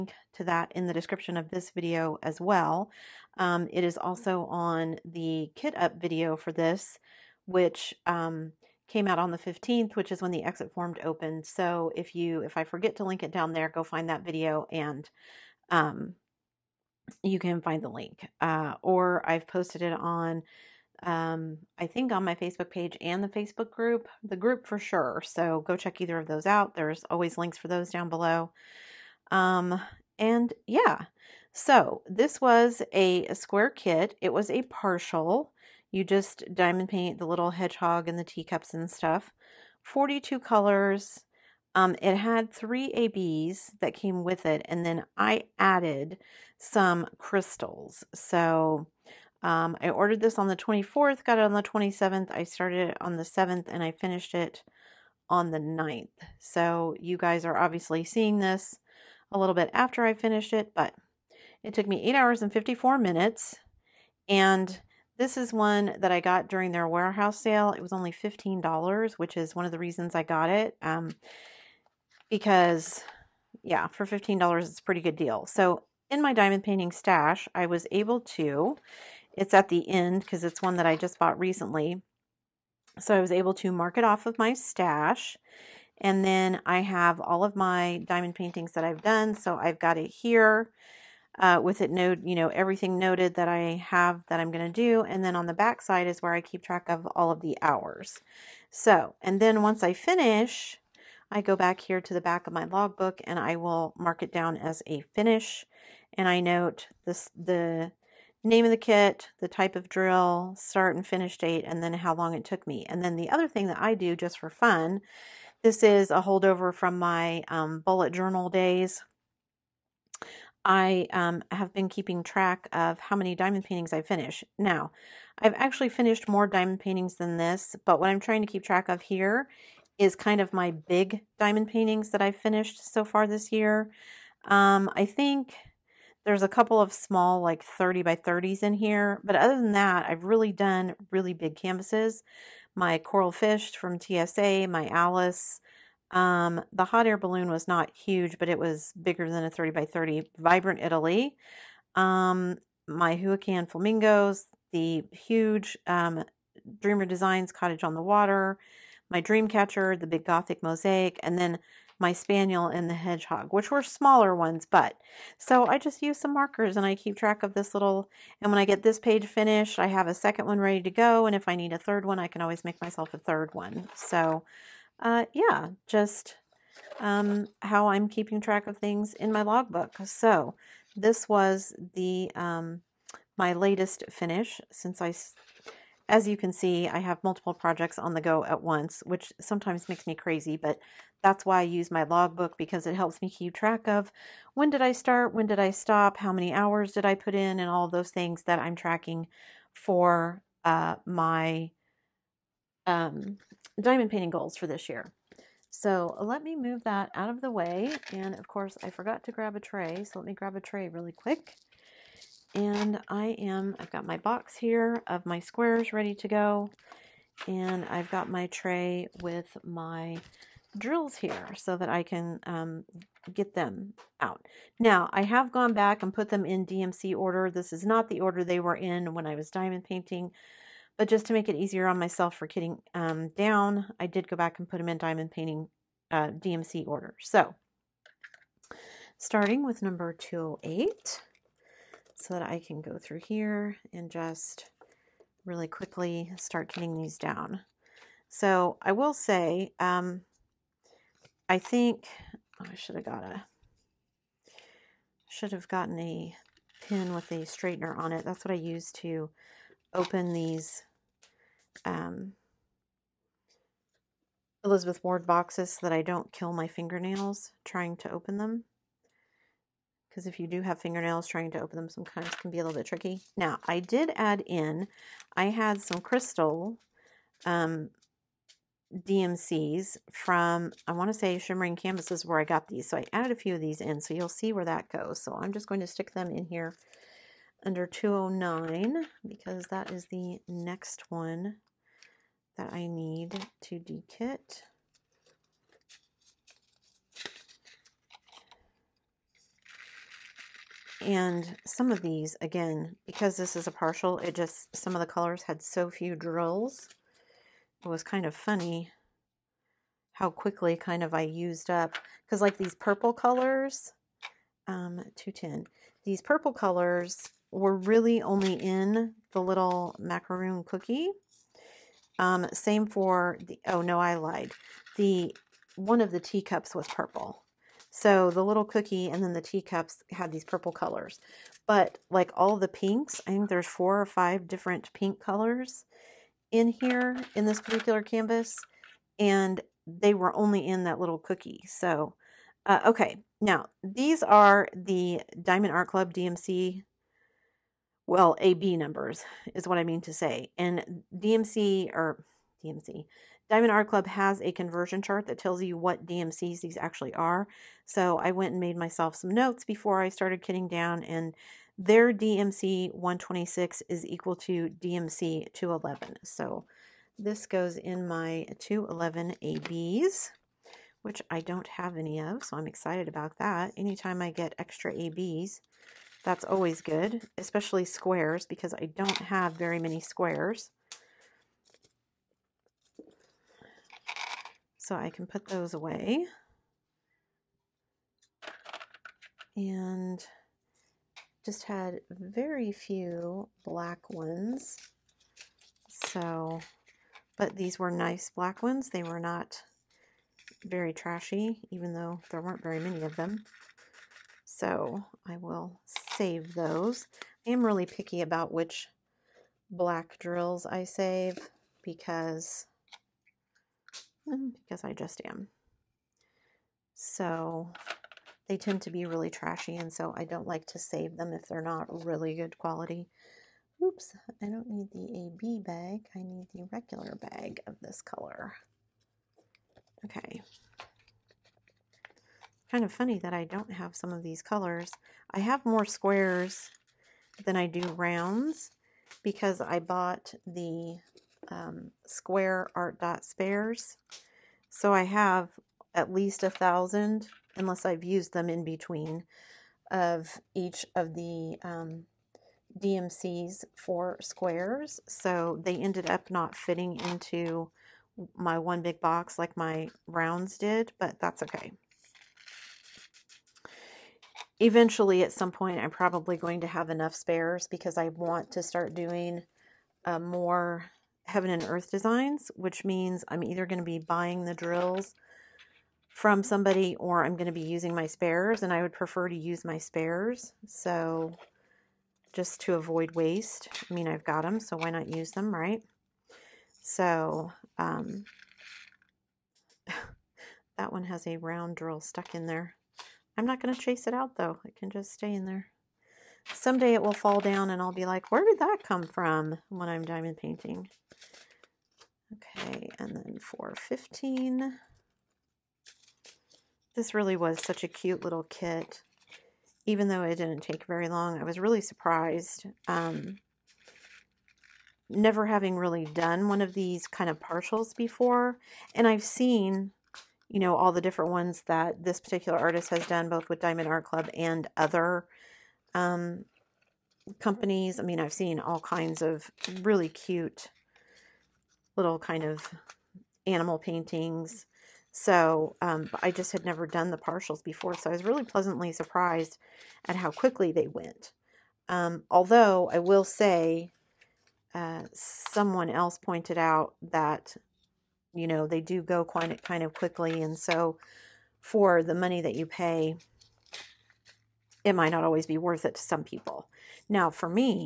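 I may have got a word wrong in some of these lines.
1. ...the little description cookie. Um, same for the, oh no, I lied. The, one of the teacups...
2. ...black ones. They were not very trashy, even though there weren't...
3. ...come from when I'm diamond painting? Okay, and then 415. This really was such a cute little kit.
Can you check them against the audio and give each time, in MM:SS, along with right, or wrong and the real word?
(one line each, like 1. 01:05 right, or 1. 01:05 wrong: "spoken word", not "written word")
1. 05:19 wrong: "macaroon", not "description"
2. 06:38 right
3. 08:18 right.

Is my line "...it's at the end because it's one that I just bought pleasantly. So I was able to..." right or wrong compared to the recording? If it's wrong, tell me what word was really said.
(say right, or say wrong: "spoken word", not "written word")
wrong: "recently", not "pleasantly".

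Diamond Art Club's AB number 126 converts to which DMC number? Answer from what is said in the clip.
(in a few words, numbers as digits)
211.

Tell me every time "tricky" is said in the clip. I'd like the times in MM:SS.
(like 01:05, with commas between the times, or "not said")
04:32.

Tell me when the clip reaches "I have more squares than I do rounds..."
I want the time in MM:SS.
07:15.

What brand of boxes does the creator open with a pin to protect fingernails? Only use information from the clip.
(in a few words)
Elizabeth Ward.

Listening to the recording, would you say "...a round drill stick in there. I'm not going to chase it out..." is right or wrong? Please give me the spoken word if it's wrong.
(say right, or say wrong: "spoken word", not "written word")
wrong: "stuck", not "stick".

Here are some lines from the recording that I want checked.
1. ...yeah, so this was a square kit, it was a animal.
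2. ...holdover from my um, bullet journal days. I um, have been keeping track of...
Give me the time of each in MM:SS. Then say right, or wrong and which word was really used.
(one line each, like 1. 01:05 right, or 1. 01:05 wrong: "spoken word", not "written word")
1. 00:30 wrong: "partial", not "animal"
2. 01:56 right.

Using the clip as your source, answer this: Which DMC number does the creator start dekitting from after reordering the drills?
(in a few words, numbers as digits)
208.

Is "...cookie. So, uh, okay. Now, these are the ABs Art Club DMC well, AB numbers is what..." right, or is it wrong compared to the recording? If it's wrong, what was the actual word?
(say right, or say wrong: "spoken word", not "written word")
wrong: "Diamond", not "ABs".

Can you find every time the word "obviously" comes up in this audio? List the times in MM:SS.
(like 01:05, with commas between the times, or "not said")
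00:57.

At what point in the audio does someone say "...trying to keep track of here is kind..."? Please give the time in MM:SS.
02:08.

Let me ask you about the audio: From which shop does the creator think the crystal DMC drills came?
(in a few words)
Shimmering Canvases.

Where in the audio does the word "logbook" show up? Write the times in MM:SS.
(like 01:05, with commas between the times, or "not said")
01:42, 02:59, 03:12.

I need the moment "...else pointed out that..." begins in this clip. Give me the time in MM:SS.
09:05.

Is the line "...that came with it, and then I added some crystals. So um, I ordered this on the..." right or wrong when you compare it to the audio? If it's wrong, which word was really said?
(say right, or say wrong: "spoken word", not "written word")
right.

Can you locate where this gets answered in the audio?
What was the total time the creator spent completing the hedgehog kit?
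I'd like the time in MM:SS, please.
01:02.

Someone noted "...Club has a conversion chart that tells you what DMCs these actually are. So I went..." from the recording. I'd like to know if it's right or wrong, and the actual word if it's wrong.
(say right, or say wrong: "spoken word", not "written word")
right.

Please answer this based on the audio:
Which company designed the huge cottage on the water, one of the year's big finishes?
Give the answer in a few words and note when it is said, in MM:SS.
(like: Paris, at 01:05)
Dreamer Designs, at 02:36.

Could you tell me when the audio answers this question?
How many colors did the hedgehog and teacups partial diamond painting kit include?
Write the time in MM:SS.
00:39.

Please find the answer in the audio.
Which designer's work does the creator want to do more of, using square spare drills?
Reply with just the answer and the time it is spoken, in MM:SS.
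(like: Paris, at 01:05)
Heaven and Earth Designs, at 07:51.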